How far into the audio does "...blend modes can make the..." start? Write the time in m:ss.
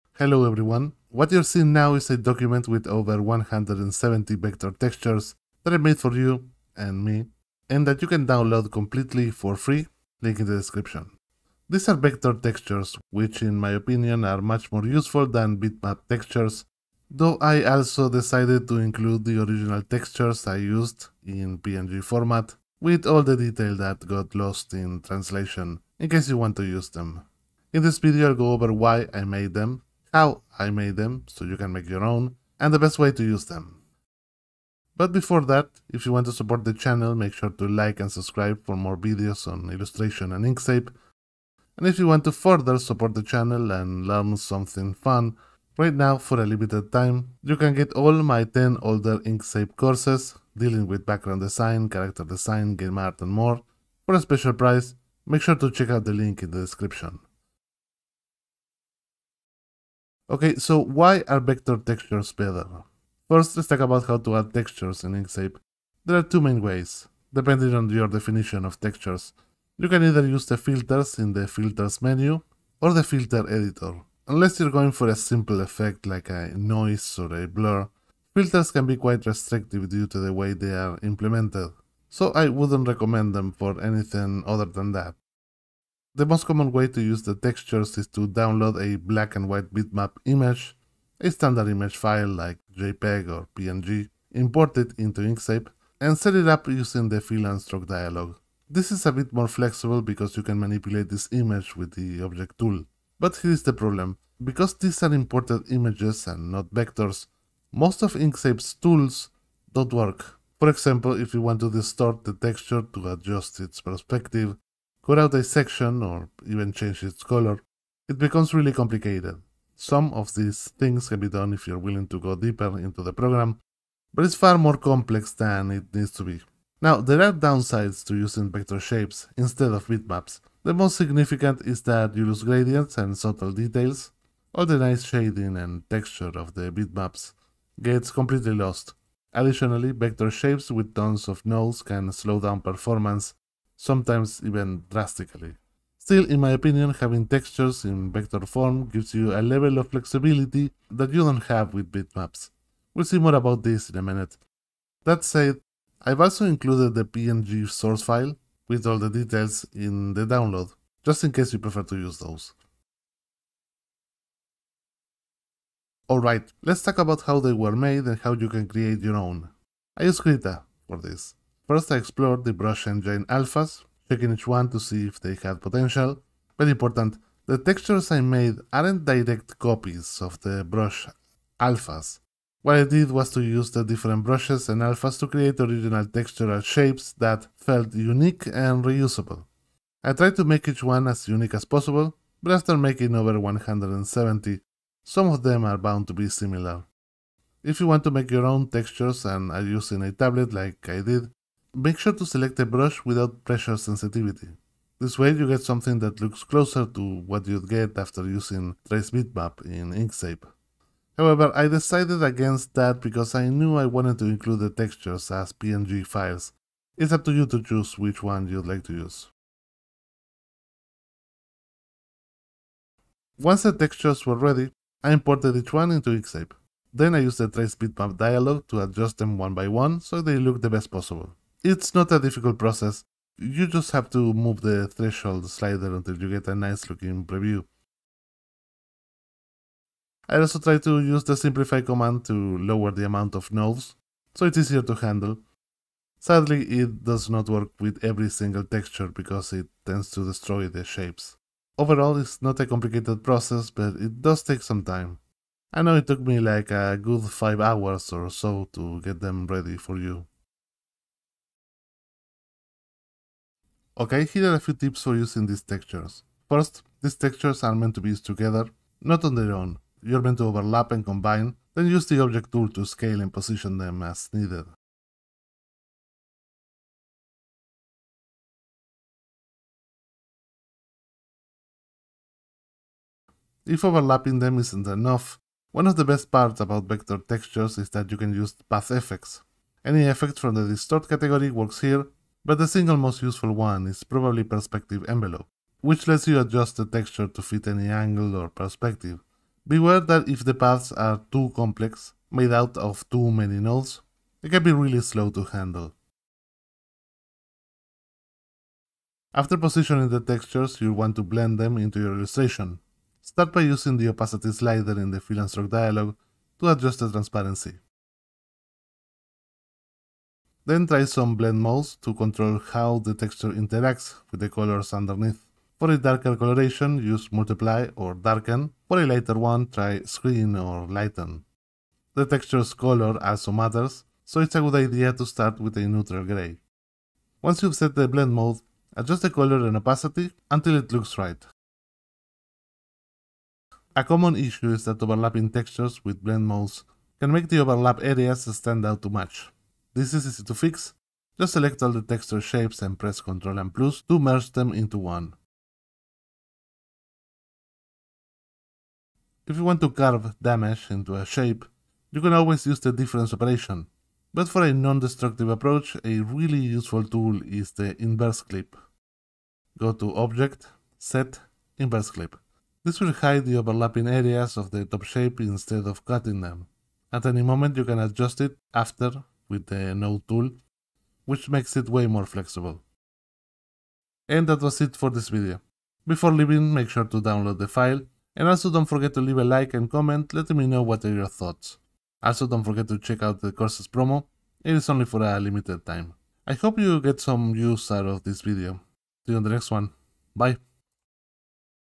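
5:46.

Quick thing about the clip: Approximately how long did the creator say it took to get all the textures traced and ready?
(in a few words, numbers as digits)
5 hours.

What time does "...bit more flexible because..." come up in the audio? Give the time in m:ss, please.
1:39.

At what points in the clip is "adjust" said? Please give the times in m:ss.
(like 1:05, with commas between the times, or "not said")
1:53, 3:48, 4:56, 5:16, 5:38, 6:17.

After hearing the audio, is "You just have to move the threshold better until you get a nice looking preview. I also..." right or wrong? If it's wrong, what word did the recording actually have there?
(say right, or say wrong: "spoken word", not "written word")
wrong: "slider", not "better".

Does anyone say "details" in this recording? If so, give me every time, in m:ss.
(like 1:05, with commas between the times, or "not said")
0:23, 2:13, 2:39.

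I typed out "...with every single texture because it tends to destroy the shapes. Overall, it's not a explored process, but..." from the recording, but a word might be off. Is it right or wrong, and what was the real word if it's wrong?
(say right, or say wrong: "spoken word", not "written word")
wrong: "complicated", not "explored".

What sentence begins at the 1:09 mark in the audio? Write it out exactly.
You can either use the filters in the filters menu or the filter editor.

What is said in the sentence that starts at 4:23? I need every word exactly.
Okay, here are a few tips for using these textures.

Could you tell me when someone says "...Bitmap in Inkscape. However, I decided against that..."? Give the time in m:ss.
3:29.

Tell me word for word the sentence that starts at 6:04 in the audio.
But for a non-destructive approach, a really useful tool is the inverse clip.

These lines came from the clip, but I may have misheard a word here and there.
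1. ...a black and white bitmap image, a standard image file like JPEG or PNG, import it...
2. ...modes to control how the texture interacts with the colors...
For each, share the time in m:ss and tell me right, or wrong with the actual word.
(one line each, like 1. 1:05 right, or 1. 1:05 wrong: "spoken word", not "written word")
1. 1:28 right
2. 5:21 right.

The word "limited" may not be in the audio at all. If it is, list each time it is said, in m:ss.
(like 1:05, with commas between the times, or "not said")
0:46, 6:35.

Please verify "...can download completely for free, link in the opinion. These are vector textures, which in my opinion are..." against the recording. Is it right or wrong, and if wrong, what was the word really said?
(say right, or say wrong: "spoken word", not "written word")
wrong: "description", not "opinion".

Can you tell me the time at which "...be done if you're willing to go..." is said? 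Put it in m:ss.
2:01.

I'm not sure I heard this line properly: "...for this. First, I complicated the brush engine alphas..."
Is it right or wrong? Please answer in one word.
wrong.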